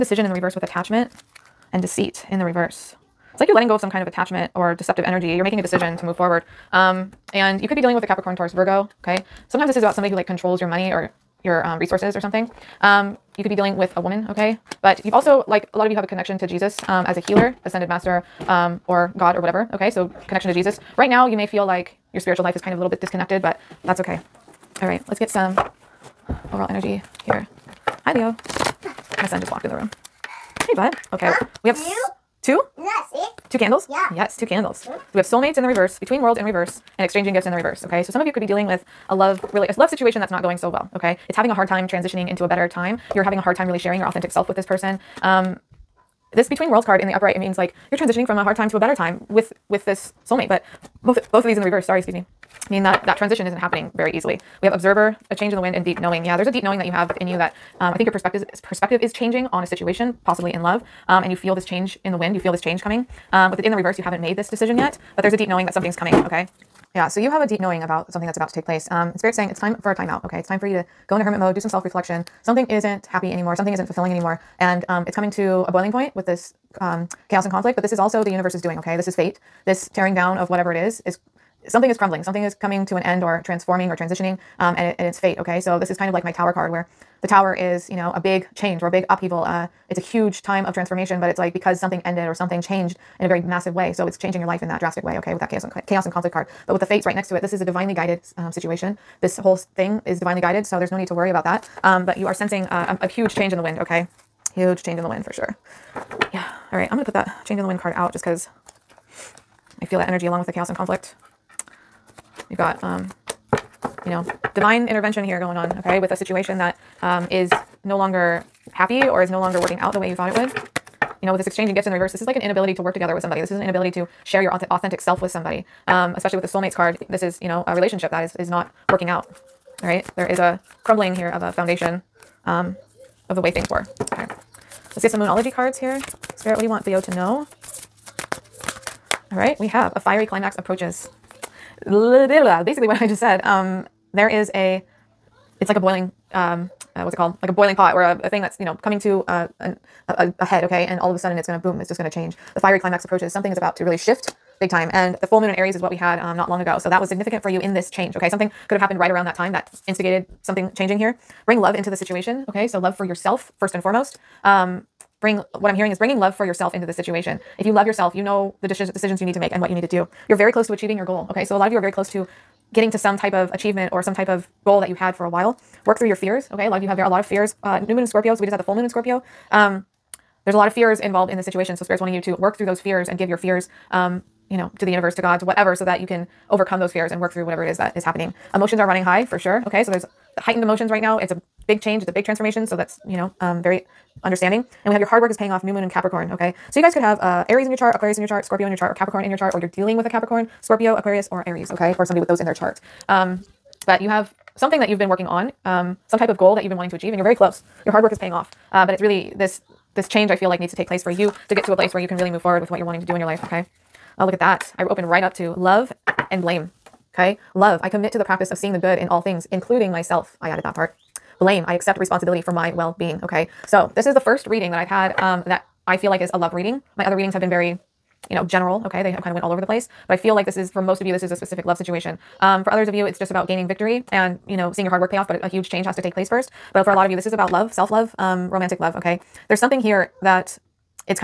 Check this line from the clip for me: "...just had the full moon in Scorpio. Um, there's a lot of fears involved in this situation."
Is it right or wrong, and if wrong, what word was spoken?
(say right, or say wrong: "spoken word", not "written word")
right.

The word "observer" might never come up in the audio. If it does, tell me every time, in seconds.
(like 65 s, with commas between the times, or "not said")
54 s.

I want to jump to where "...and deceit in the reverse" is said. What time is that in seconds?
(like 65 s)
1 s.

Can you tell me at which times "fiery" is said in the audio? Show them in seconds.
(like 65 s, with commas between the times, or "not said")
139 s, 152 s.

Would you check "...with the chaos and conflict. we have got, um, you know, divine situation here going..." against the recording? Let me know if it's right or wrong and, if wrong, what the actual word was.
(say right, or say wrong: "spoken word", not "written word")
wrong: "intervention", not "situation".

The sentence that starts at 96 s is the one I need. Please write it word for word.
But with the fates right next to it, this is a divinely guided um, situation.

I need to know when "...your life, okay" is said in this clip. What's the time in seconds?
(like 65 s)
213 s.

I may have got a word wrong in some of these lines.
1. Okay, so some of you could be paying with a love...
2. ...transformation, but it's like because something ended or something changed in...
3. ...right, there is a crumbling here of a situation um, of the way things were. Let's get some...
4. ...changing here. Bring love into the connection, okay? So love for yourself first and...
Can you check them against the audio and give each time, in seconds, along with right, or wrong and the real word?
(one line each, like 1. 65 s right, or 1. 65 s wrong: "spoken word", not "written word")
1. 37 s wrong: "dealing", not "paying"
2. 90 s right
3. 129 s wrong: "foundation", not "situation"
4. 160 s wrong: "situation", not "connection".